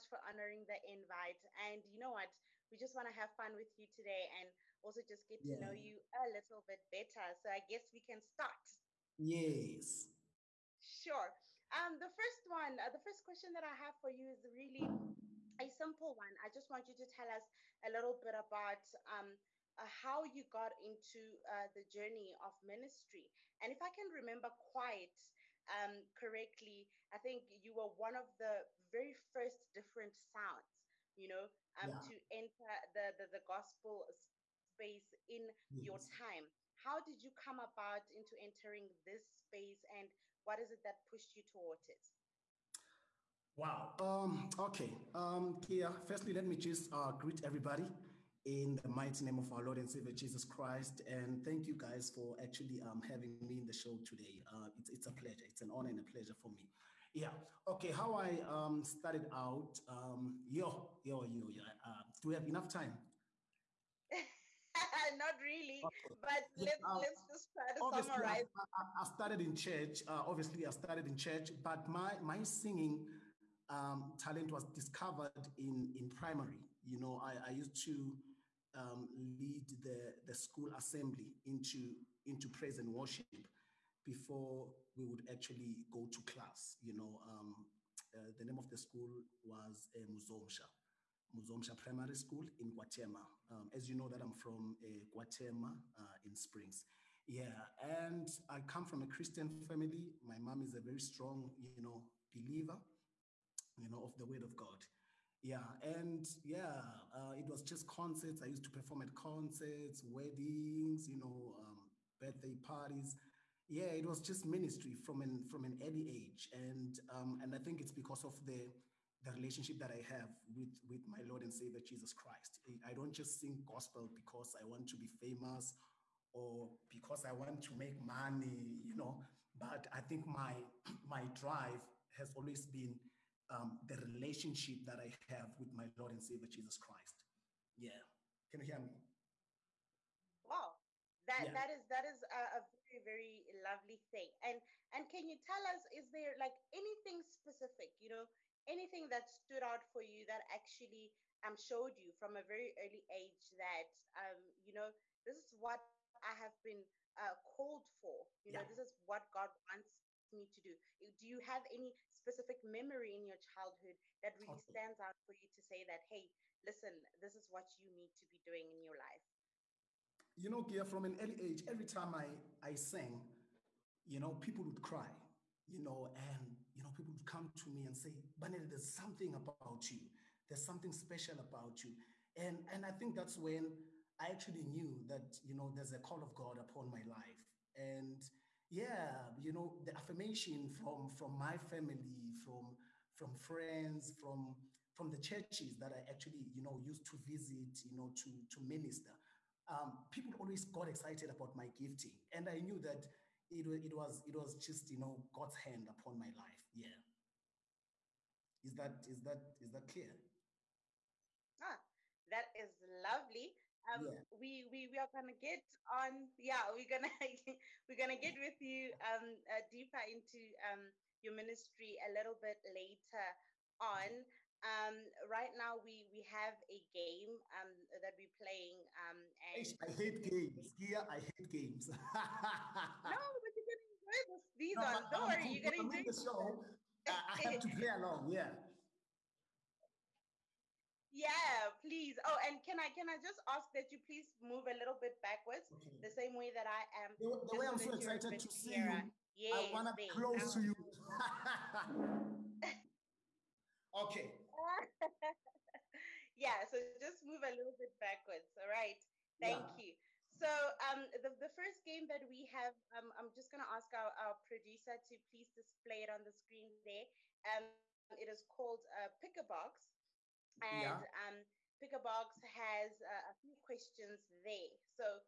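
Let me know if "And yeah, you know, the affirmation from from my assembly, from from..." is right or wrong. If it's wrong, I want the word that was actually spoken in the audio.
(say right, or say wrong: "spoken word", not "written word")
wrong: "family", not "assembly".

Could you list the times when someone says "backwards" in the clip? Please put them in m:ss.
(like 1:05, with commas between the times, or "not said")
4:05, 4:17.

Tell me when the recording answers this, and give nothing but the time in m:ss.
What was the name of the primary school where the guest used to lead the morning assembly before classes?
1:31.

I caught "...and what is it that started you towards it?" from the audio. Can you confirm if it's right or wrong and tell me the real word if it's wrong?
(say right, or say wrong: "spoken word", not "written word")
wrong: "pushed", not "started".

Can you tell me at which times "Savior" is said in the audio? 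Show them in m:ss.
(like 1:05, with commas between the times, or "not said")
0:49, 2:01, 2:16.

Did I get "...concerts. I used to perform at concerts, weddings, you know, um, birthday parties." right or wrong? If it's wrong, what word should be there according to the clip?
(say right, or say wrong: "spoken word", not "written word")
right.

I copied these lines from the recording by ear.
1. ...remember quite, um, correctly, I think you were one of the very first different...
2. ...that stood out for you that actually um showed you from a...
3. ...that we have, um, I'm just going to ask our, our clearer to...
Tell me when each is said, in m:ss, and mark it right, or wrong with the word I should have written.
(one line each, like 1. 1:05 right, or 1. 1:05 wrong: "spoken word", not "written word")
1. 0:24 right
2. 2:29 right
3. 4:22 wrong: "producer", not "clearer".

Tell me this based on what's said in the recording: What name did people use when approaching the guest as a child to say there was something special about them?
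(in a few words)
Banel.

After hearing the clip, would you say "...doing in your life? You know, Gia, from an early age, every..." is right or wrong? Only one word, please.
right.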